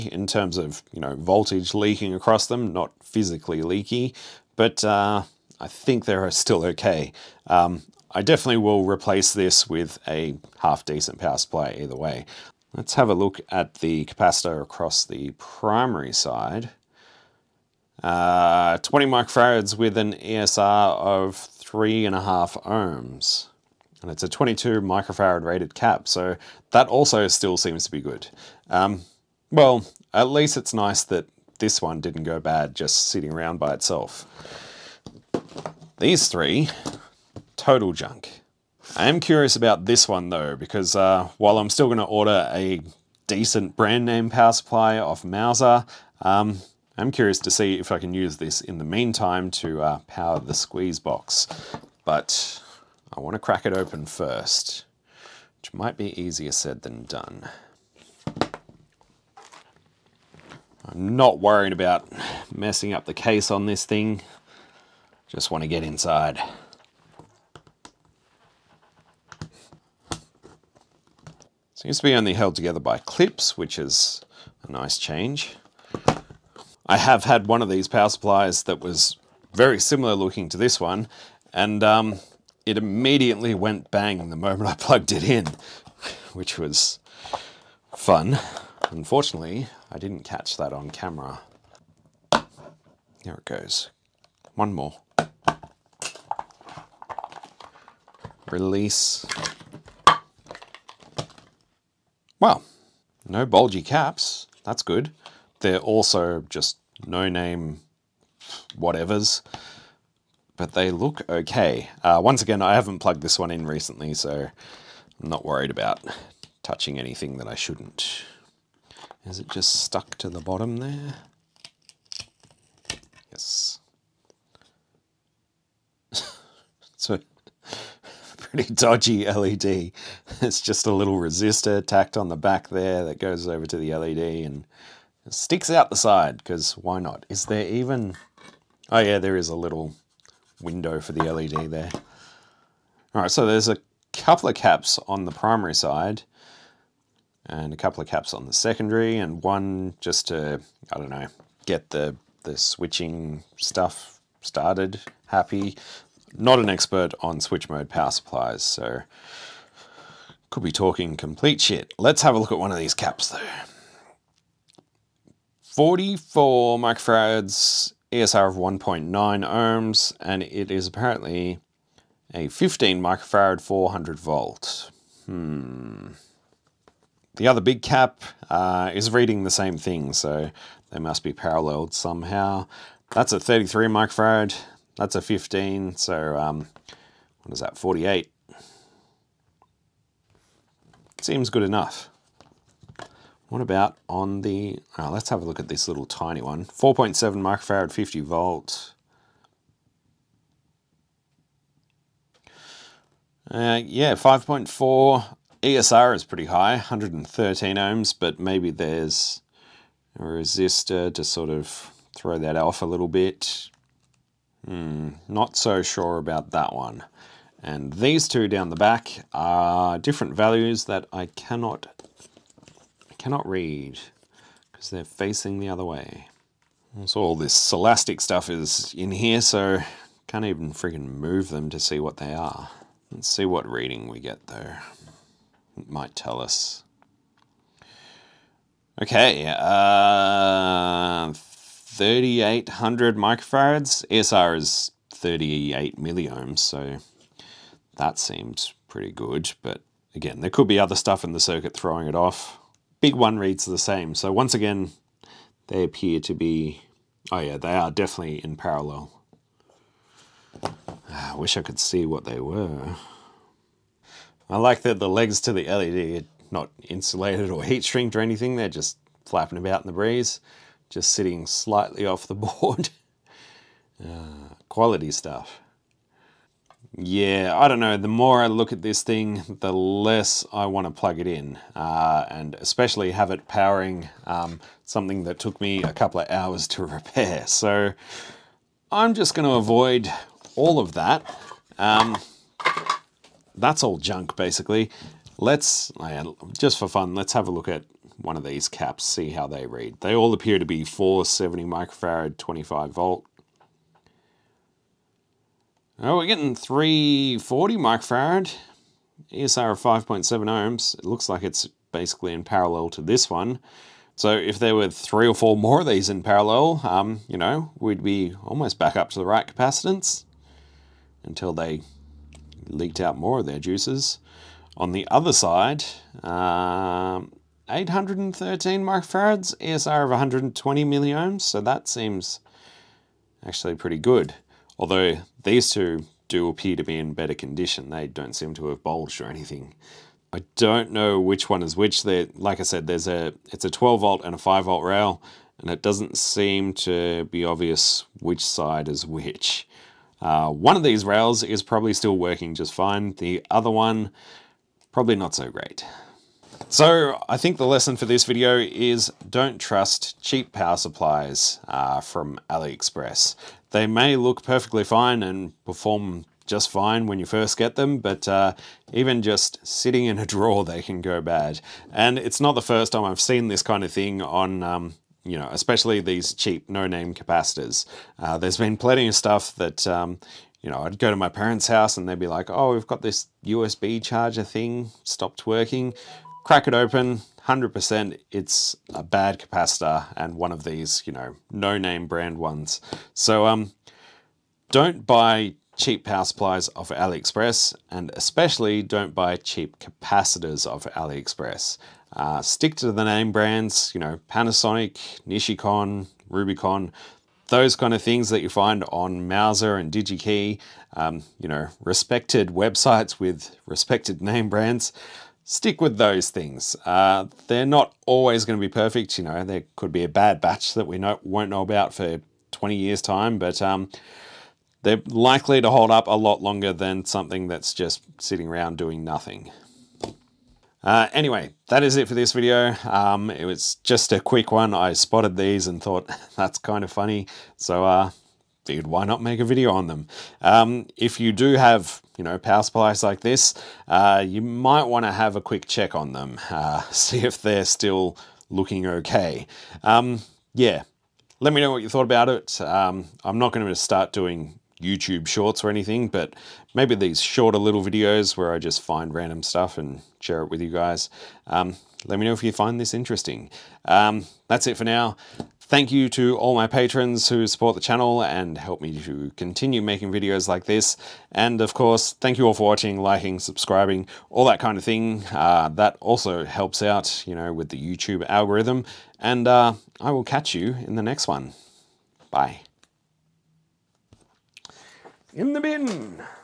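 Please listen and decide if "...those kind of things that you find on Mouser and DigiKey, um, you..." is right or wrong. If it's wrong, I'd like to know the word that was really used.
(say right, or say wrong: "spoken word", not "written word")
right.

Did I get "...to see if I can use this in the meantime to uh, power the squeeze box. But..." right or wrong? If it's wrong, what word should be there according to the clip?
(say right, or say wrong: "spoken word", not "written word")
right.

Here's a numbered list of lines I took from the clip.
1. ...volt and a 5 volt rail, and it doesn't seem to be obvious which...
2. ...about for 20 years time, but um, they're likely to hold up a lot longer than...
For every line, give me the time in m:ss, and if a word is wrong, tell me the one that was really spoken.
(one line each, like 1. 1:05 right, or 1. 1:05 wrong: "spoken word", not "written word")
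1. 5:44 right
2. 7:01 right.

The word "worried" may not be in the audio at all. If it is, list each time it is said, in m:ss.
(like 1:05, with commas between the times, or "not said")
1:01, 1:55.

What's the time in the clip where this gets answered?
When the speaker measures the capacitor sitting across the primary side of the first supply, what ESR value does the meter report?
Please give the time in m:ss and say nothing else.
0:21.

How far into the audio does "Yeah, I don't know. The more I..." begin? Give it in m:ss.
4:36.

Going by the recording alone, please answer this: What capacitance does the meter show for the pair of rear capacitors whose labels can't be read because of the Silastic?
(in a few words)
3,800 microfarads.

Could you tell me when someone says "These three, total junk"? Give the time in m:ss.
0:36.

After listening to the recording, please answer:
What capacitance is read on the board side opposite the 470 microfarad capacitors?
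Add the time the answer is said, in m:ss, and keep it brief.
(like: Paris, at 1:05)
813 microfarads, at 5:27.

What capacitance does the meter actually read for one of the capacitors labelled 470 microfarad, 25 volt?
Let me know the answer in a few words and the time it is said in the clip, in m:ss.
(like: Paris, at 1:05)
340 microfarad, at 5:06.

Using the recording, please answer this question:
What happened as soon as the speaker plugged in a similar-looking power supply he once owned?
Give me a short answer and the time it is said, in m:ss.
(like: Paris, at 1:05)
went bang, at 1:23.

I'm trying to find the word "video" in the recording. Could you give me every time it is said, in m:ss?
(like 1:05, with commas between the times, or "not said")
5:58, 7:12, 7:19, 7:37, 7:50.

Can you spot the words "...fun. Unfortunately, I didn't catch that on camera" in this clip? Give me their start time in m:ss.
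1:27.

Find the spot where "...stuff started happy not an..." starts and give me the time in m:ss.
2:33.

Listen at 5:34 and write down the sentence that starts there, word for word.
Although these two do appear to be in better condition.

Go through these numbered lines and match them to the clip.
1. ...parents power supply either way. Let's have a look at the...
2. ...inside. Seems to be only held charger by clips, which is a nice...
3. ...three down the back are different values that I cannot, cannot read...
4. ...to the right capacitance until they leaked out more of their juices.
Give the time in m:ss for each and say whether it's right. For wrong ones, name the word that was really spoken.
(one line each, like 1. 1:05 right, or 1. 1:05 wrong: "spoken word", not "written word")
1. 0:10 wrong: "decent", not "parents"
2. 1:05 wrong: "together", not "charger"
3. 3:38 wrong: "two", not "three"
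4. 5:19 right.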